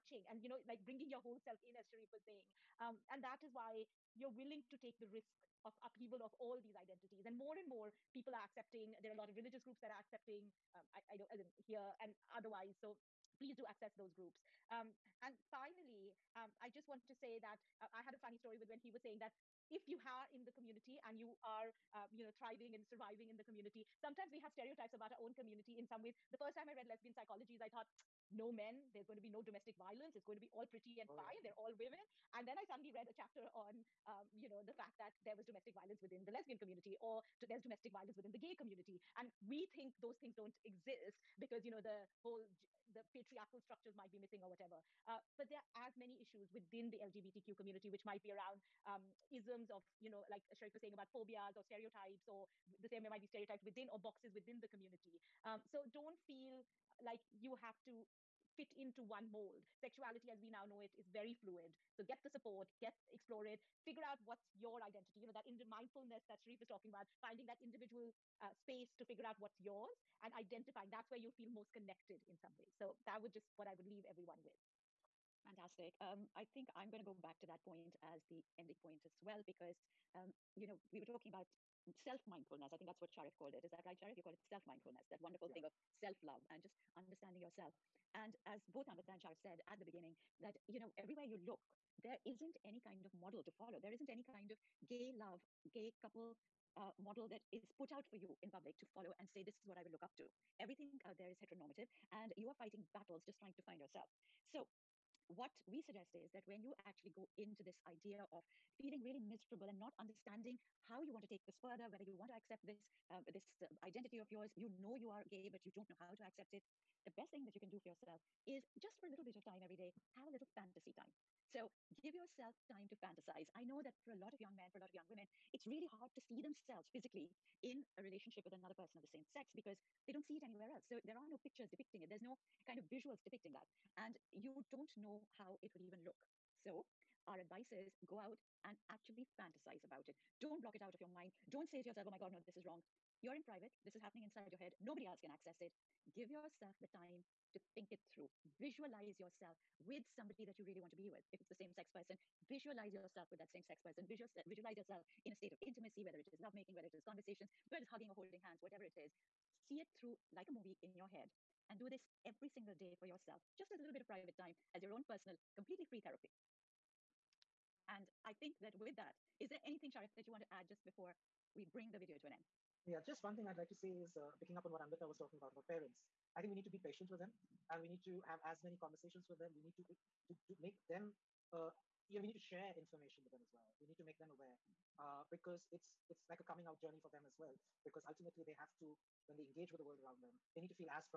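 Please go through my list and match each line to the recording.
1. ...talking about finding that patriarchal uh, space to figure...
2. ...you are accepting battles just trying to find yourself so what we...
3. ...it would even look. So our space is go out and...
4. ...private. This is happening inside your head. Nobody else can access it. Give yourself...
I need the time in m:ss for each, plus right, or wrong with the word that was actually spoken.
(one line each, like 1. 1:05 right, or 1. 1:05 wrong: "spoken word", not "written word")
1. 1:06 wrong: "individual", not "patriarchal"
2. 1:42 wrong: "fighting", not "accepting"
3. 2:15 wrong: "advice", not "space"
4. 2:23 right.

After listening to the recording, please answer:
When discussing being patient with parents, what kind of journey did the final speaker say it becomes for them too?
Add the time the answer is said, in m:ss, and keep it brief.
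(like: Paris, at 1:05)
coming out journey, at 3:06.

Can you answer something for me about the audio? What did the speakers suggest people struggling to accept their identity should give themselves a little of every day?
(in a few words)
fantasy time.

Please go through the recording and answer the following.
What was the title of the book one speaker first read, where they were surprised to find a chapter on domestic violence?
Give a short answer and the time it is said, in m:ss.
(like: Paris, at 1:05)
Lesbian Psychologies, at 0:26.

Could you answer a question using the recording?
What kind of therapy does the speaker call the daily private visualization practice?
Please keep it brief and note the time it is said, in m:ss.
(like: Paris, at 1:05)
completely free therapy, at 2:45.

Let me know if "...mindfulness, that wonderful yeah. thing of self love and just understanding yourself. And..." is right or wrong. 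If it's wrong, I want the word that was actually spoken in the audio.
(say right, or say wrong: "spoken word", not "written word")
right.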